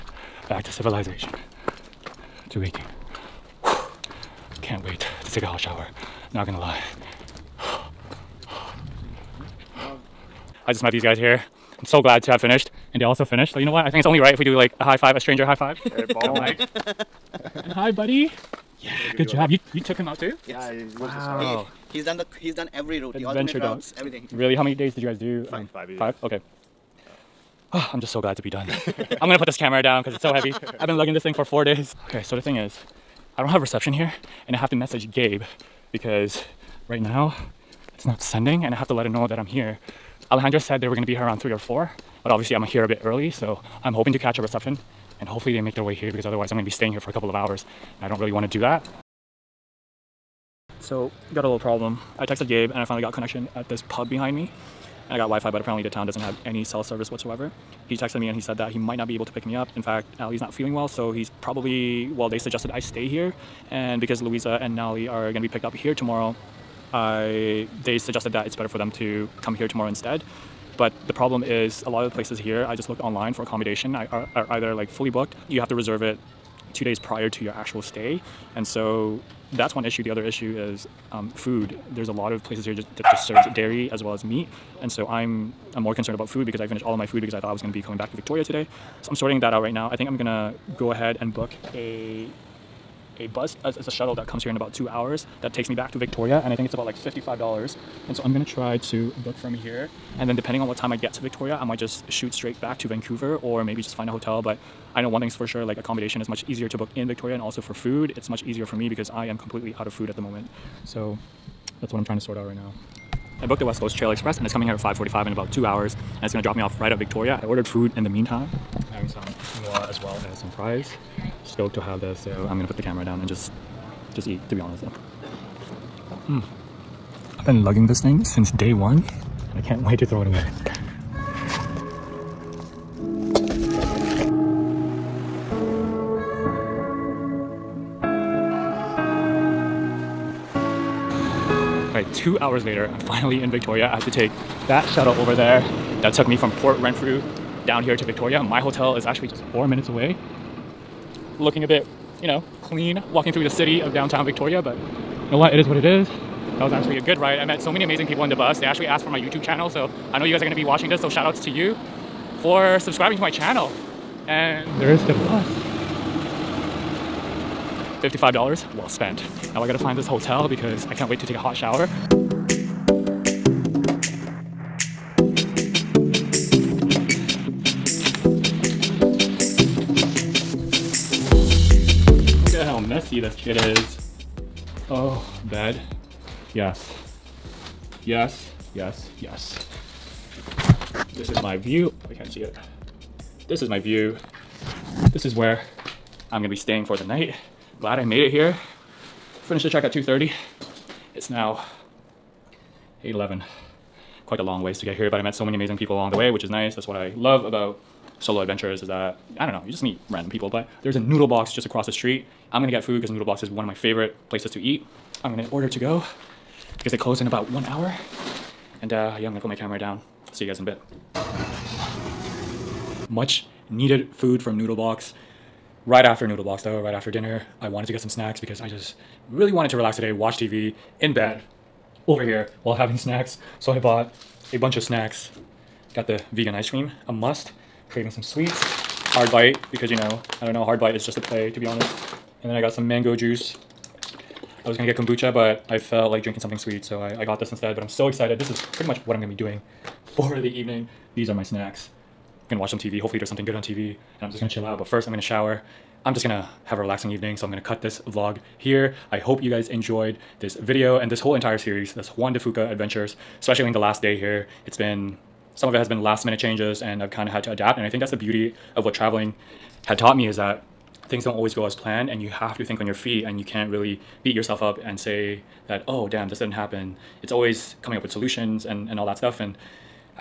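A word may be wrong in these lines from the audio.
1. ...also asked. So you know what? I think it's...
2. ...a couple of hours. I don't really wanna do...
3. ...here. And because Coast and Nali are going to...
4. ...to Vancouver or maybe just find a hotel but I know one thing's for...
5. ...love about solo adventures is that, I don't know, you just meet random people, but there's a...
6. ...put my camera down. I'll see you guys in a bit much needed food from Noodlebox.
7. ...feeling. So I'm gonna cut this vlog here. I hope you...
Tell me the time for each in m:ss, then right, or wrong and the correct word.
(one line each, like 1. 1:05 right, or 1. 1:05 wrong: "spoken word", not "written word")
1. 0:13 wrong: "finished", not "asked"
2. 0:47 right
3. 1:03 wrong: "Louisa", not "Coast"
4. 1:42 right
5. 3:27 right
6. 3:39 right
7. 4:17 wrong: "evening", not "feeling".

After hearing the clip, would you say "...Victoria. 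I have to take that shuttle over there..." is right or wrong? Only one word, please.
right.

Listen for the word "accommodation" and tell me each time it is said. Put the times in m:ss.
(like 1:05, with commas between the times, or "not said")
1:13, 1:45.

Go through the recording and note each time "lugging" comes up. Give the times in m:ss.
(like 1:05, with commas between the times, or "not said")
0:30, 2:07.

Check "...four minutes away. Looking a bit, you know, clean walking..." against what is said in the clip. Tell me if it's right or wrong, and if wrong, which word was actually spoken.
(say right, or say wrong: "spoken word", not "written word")
right.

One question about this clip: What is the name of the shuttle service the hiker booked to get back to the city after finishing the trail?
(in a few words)
West Coast Trail Express.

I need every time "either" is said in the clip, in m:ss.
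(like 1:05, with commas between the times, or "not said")
1:14.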